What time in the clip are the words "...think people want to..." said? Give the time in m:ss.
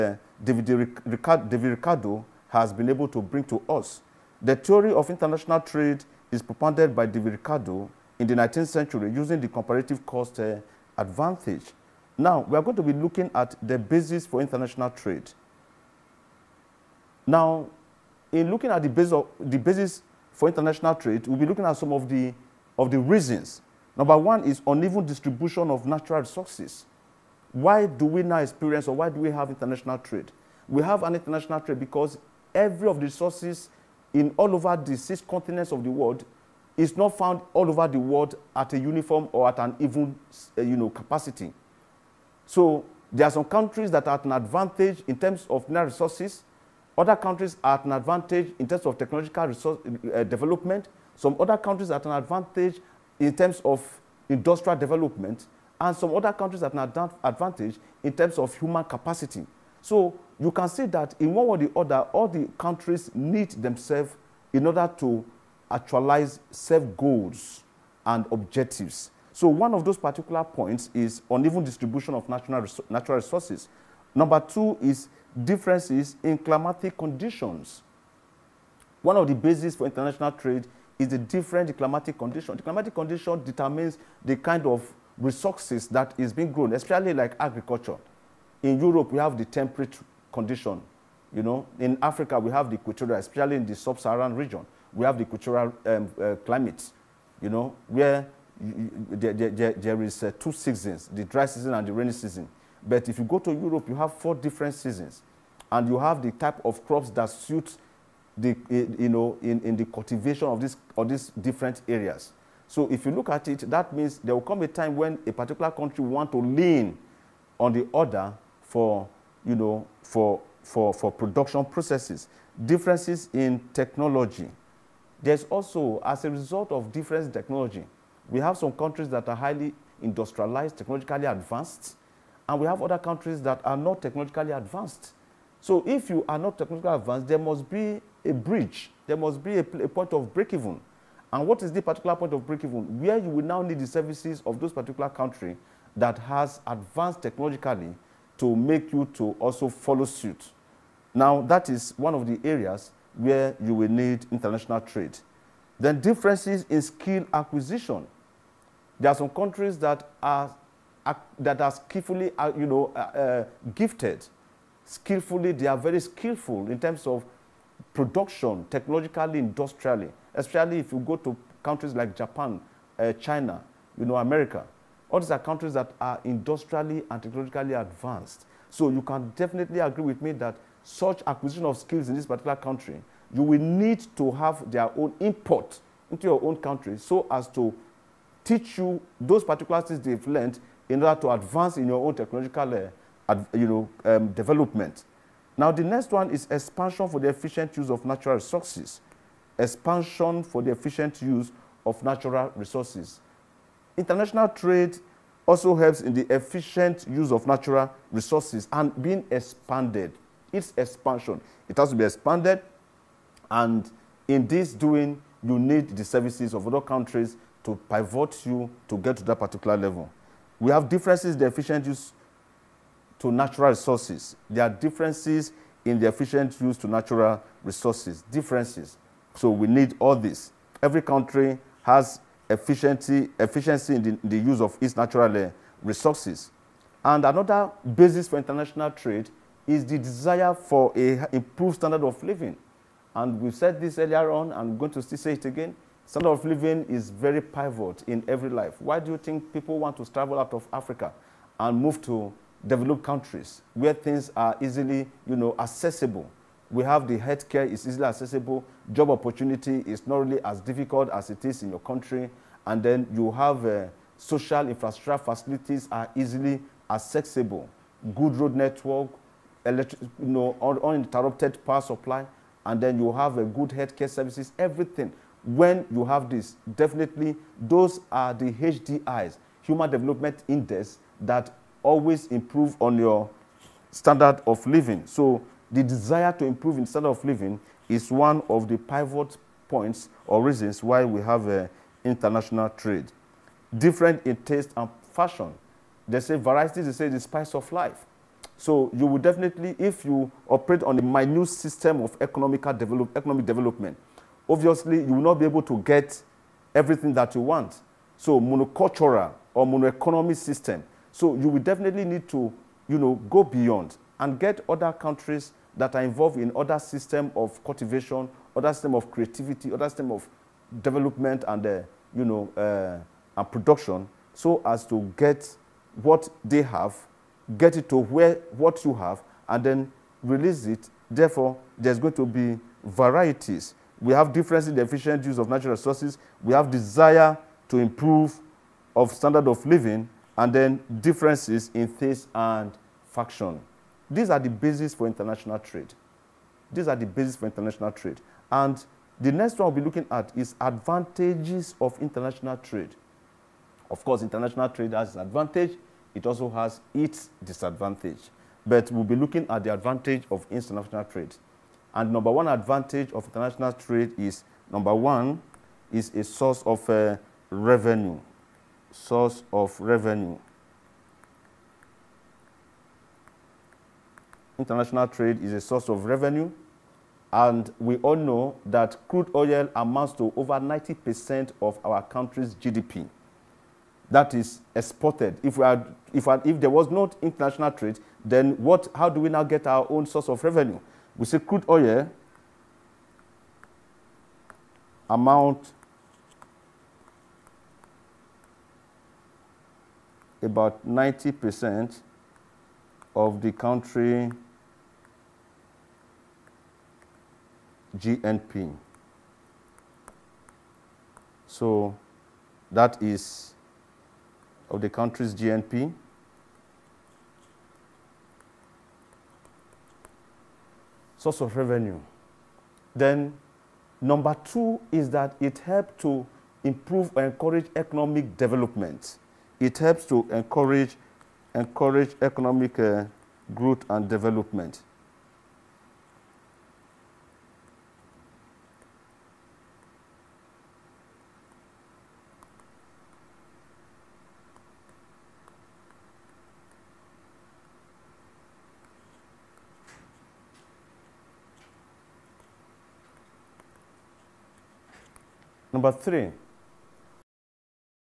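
4:09.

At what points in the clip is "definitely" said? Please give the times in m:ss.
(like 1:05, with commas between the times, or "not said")
2:59, 4:36, 4:59, 5:11.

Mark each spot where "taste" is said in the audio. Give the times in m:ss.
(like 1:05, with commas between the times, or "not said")
4:54, 5:41.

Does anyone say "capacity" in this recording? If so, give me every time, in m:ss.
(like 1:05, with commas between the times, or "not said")
0:40, 0:58.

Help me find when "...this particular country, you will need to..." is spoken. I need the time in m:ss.
3:02.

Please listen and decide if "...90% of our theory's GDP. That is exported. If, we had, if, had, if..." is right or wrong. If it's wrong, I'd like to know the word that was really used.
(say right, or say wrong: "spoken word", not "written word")
wrong: "country", not "theory".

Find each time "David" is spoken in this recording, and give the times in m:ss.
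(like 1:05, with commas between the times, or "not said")
0:00, 0:07.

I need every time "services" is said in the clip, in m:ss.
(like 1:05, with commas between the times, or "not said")
2:23, 3:36, 4:34.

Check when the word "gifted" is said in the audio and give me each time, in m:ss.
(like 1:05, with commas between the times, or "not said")
2:43.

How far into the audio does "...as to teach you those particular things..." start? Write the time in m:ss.
3:07.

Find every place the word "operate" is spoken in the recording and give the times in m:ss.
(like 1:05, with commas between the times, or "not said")
5:00.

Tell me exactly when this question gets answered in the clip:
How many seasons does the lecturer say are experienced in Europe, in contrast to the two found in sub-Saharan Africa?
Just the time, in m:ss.
1:44.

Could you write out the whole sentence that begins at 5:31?
Therefore, there's going to be varieties.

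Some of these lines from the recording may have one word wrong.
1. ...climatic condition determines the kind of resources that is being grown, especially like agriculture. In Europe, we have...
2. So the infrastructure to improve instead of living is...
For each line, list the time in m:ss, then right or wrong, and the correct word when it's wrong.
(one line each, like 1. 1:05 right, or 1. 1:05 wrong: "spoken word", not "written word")
1. 1:22 right
2. 4:45 wrong: "desire", not "infrastructure".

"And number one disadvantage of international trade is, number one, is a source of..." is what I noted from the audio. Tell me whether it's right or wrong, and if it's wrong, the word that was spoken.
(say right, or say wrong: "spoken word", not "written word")
wrong: "advantage", not "disadvantage".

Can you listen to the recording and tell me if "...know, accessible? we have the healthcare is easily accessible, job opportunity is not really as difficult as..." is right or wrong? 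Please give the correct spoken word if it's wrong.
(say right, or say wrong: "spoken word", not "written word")
right.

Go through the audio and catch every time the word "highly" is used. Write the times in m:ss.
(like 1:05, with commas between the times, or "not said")
2:09.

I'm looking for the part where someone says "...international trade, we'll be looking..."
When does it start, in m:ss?
0:20.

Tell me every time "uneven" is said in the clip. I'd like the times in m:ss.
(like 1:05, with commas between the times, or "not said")
0:24, 1:11.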